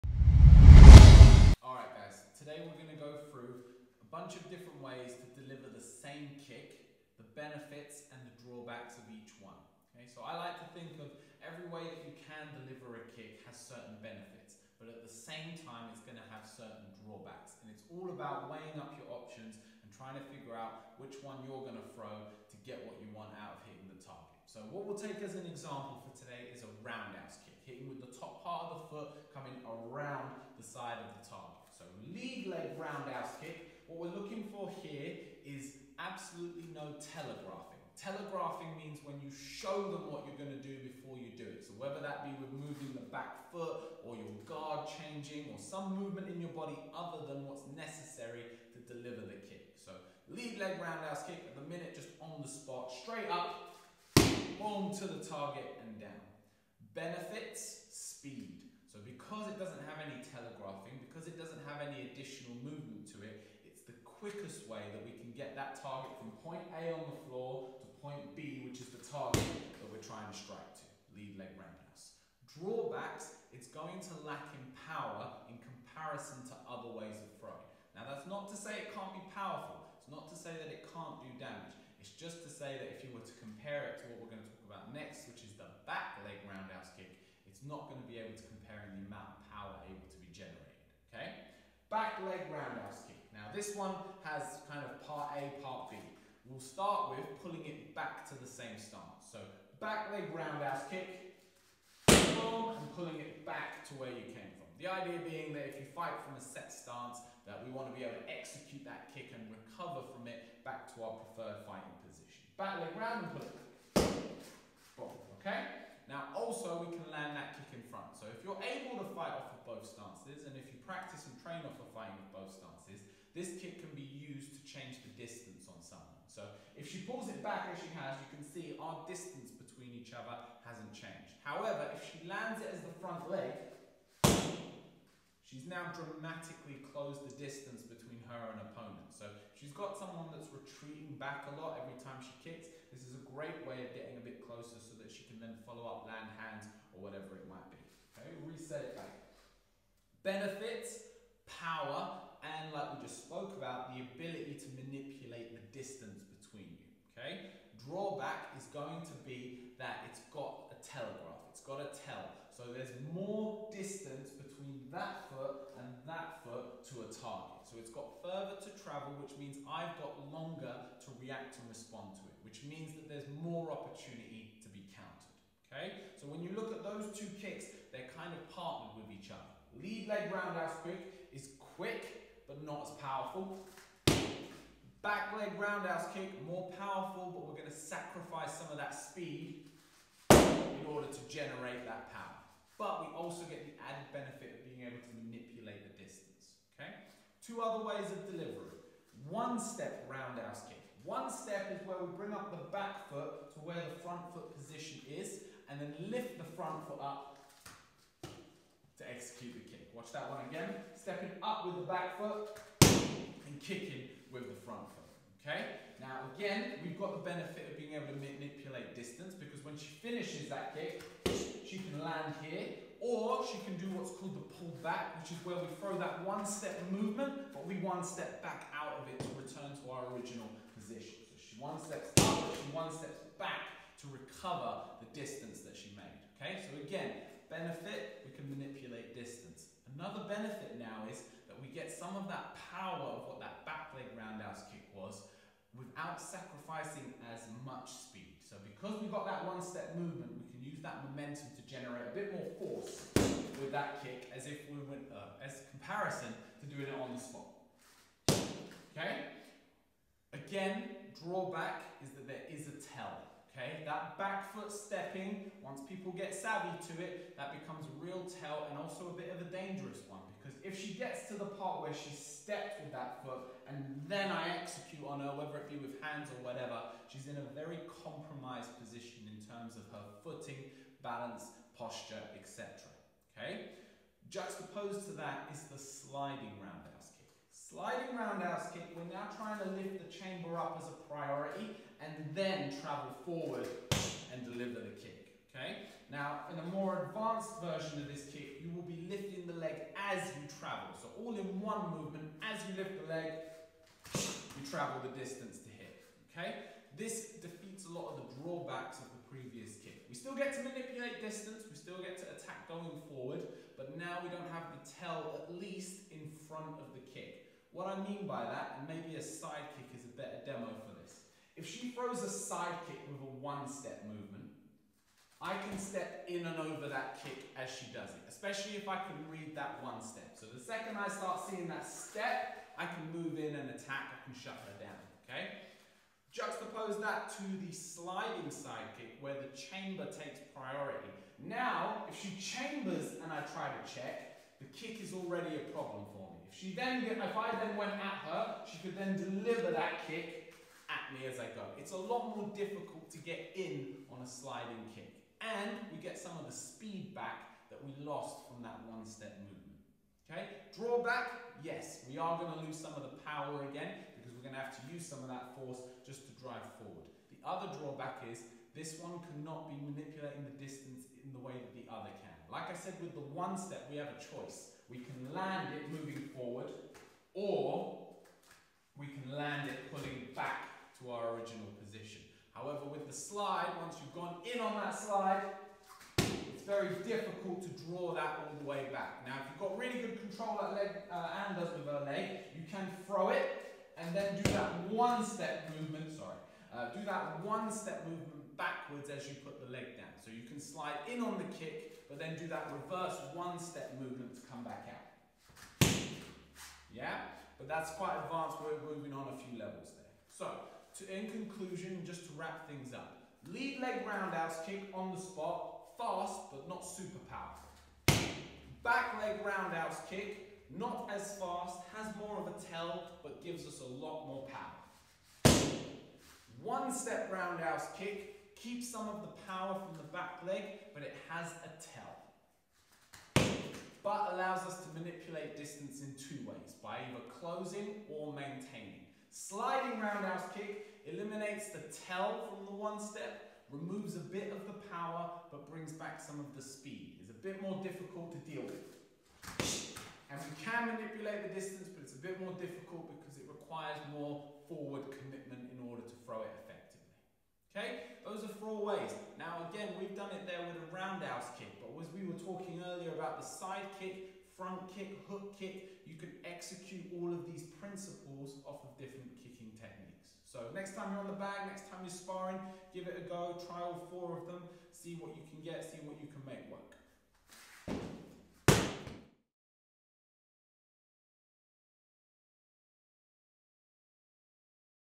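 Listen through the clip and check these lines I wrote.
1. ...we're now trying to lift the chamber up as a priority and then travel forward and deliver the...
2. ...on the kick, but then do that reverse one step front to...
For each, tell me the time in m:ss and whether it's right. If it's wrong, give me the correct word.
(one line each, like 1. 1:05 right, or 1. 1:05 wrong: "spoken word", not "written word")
1. 4:48 right
2. 6:41 wrong: "movement", not "front".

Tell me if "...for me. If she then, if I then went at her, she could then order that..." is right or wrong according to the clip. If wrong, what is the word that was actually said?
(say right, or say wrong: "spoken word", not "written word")
wrong: "deliver", not "order".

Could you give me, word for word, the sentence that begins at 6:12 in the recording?
Like I said with the one step, we have a choice.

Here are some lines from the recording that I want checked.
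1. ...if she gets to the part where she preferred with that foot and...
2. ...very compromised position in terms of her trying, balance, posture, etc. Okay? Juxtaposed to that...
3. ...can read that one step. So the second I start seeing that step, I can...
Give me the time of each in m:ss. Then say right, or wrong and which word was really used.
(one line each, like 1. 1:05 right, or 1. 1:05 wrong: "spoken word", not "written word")
1. 4:30 wrong: "stepped", not "preferred"
2. 4:37 wrong: "footing", not "trying"
3. 5:28 right.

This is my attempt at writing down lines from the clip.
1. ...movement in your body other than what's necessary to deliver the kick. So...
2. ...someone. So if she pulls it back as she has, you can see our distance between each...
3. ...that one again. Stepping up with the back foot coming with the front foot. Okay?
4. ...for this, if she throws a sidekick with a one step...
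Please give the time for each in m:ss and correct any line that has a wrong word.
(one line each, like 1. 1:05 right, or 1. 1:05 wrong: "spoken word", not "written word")
1. 0:45 right
2. 2:05 right
3. 3:30 wrong: "kicking", not "coming"
4. 5:20 right.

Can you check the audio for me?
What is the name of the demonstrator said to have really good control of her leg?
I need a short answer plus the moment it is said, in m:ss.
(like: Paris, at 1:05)
Anne, at 6:31.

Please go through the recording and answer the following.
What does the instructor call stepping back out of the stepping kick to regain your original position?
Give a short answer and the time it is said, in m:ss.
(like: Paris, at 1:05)
the pull back, at 3:44.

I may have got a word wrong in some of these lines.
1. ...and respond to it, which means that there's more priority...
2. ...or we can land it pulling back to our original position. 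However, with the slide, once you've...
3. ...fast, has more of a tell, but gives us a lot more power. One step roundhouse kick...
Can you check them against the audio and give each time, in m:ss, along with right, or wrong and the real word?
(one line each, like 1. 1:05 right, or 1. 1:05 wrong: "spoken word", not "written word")
1. 2:51 wrong: "opportunity", not "priority"
2. 6:17 right
3. 7:01 right.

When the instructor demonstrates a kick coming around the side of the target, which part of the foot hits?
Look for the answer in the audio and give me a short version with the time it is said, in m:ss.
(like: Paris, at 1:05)
top part of the foot, at 0:28.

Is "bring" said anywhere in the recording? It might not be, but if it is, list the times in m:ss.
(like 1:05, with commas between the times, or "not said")
3:22, 7:25.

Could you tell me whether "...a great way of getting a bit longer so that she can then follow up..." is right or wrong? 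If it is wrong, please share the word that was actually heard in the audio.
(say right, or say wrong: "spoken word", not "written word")
wrong: "closer", not "longer".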